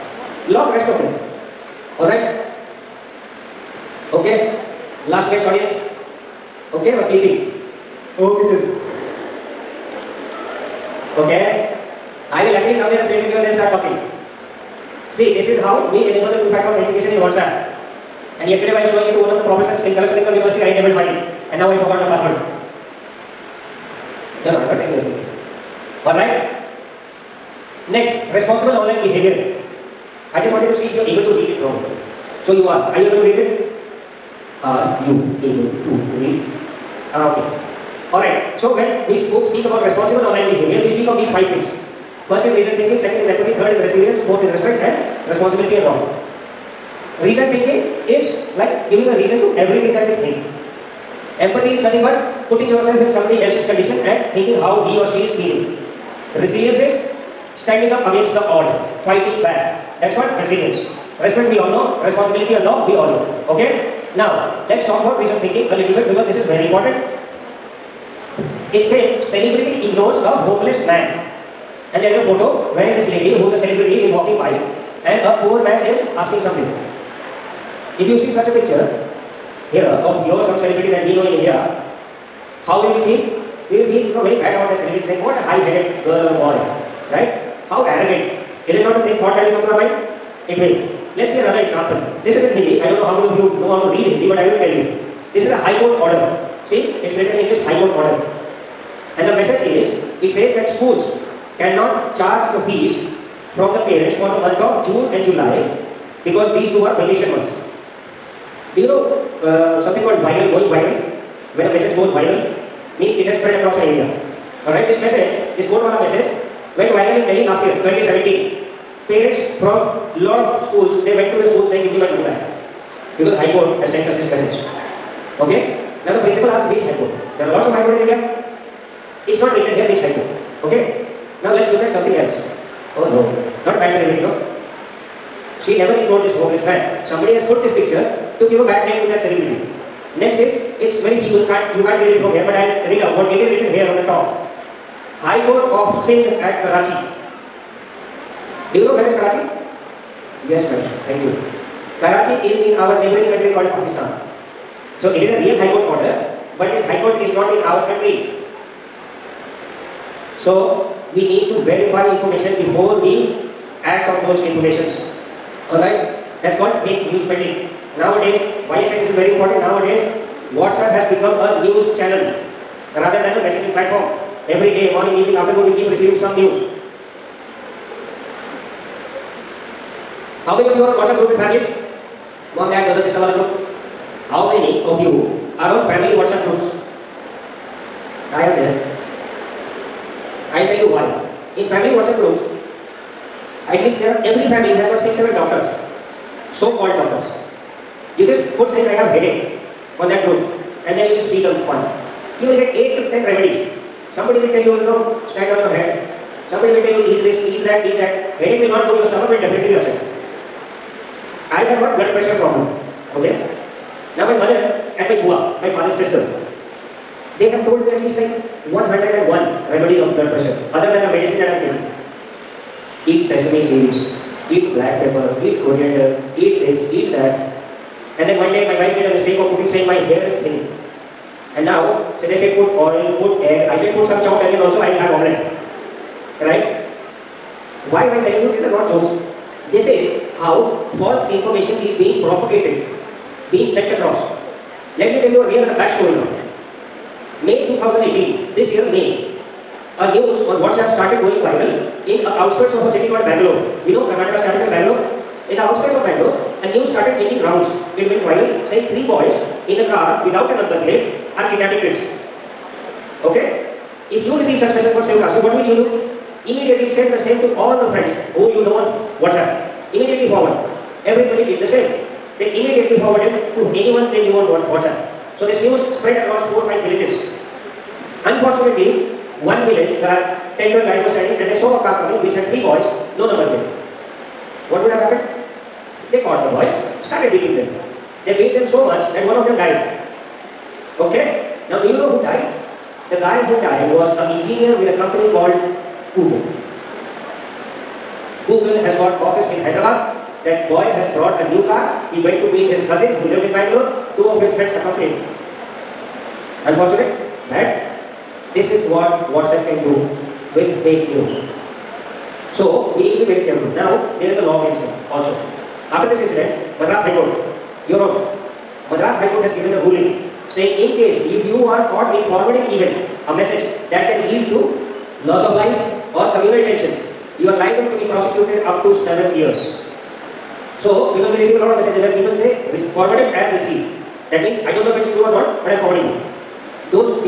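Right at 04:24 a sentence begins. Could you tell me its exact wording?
If you receive such message for Sivakasi, what will you do?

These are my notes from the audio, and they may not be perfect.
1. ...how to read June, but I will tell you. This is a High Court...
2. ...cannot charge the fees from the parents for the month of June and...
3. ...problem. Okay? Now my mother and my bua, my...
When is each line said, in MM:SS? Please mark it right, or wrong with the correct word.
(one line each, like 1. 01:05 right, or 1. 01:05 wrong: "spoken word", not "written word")
1. 01:33 wrong: "Hindi", not "June"
2. 01:41 right
3. 03:32 right.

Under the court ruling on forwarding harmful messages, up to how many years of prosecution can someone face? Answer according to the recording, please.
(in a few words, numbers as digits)
7 years.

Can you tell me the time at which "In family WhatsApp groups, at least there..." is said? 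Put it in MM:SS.
03:11.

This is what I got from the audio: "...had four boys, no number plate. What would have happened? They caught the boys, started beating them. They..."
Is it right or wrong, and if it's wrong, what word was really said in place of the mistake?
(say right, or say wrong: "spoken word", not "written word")
wrong: "three", not "four".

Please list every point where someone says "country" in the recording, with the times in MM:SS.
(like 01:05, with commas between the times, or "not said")
02:33, 02:37.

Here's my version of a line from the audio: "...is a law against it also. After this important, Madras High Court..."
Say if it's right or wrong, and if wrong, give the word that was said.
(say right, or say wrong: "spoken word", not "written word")
wrong: "incident", not "important".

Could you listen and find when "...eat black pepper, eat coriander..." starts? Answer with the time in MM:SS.
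03:44.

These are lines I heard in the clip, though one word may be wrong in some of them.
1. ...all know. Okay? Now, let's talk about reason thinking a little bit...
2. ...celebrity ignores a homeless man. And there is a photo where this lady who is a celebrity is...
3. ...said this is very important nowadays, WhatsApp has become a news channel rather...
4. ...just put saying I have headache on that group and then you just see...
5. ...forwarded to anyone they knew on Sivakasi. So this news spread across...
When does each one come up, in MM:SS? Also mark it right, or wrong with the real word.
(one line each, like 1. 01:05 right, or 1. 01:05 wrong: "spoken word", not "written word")
1. 01:02 right
2. 01:09 right
3. 02:48 right
4. 03:18 right
5. 04:33 wrong: "WhatsApp", not "Sivakasi".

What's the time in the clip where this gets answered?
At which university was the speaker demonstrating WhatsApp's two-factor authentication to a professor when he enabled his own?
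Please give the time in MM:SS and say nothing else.
00:19.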